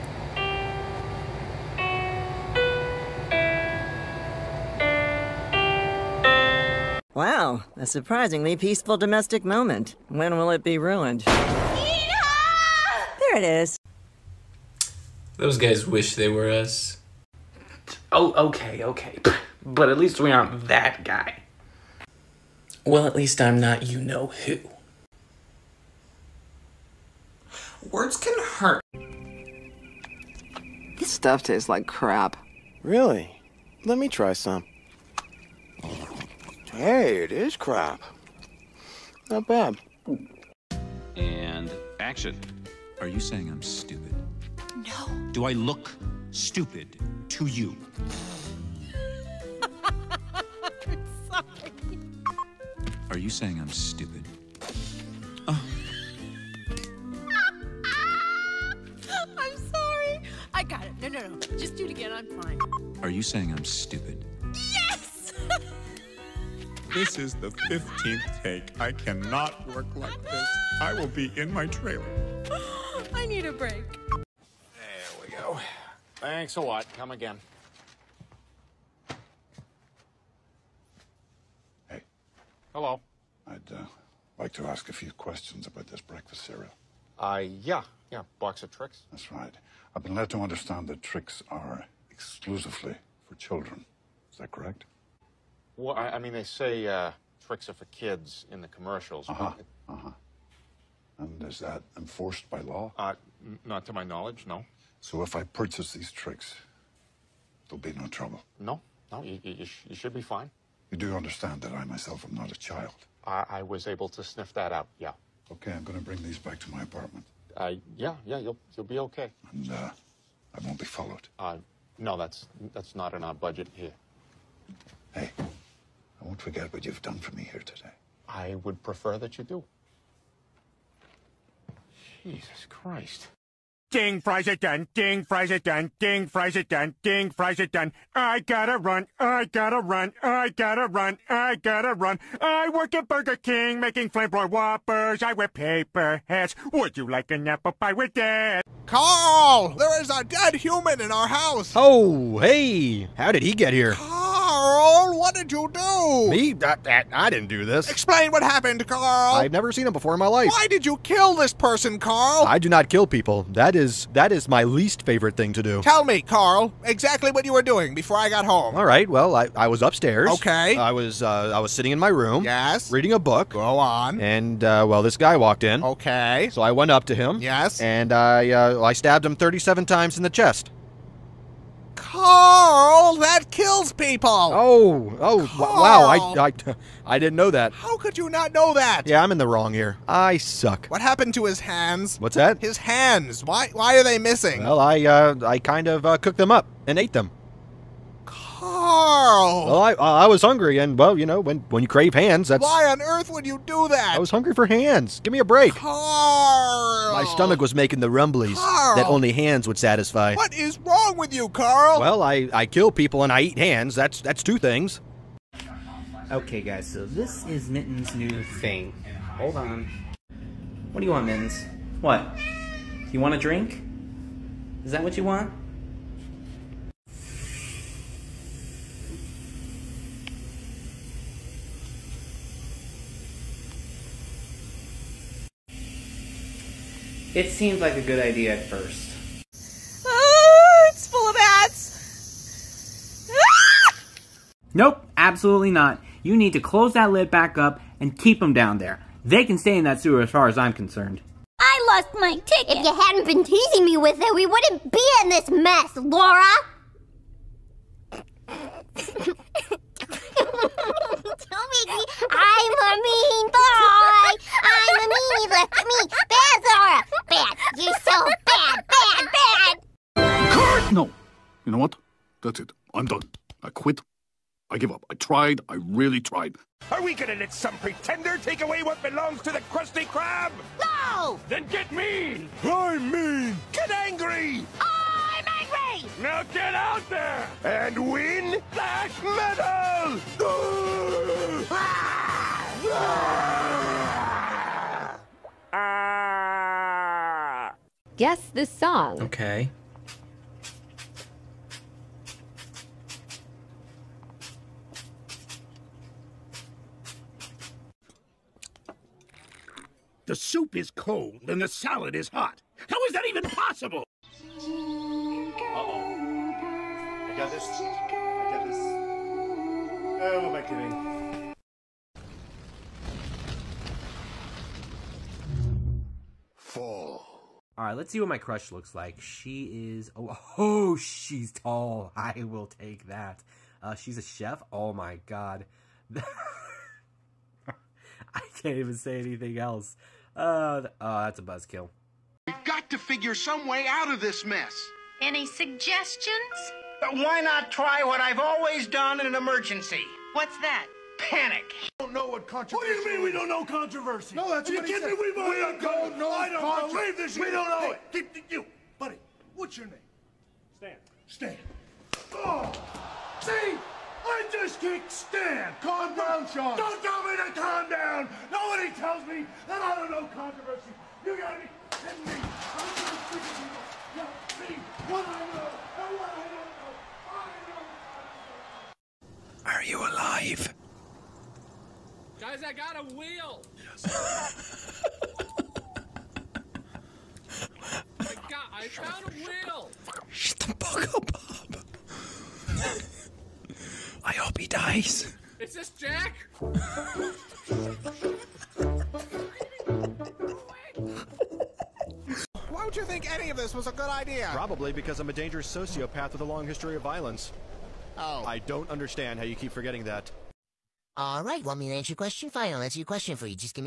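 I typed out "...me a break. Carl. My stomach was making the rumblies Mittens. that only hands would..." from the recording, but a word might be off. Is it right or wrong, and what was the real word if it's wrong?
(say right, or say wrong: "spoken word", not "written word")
wrong: "Carl", not "Mittens".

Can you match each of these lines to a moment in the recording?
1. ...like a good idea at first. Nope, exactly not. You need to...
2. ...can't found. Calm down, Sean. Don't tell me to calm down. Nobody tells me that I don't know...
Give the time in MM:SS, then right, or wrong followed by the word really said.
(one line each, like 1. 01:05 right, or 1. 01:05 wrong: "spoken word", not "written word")
1. 03:57 wrong: "absolutely", not "exactly"
2. 06:04 wrong: "stand", not "found".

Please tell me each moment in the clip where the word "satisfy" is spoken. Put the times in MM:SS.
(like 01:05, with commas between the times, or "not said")
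03:29.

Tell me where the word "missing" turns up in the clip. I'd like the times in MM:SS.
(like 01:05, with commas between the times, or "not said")
03:14.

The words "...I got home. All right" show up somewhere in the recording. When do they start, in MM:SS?
02:48.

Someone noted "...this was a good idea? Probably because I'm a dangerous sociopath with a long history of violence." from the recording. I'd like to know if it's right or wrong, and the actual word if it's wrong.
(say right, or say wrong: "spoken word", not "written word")
right.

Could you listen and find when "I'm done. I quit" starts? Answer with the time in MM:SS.
04:32.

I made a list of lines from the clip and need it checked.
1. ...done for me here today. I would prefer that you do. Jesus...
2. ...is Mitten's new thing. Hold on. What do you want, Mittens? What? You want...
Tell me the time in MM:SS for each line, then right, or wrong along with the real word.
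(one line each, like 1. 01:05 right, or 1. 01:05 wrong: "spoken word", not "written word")
1. 02:07 right
2. 03:37 right.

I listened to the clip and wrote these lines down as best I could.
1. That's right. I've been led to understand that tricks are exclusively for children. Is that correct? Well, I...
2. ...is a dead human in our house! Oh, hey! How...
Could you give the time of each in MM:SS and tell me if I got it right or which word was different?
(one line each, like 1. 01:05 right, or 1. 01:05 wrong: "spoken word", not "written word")
1. 01:29 right
2. 02:30 right.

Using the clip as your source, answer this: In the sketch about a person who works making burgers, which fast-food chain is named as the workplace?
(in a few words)
Burger King.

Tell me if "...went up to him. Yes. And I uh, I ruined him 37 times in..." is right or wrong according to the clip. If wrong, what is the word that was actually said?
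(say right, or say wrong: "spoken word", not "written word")
wrong: "stabbed", not "ruined".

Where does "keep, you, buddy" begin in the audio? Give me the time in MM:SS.
05:58.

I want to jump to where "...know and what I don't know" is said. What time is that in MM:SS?
06:15.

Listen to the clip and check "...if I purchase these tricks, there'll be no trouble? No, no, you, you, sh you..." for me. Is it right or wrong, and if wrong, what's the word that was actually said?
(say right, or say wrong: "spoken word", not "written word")
right.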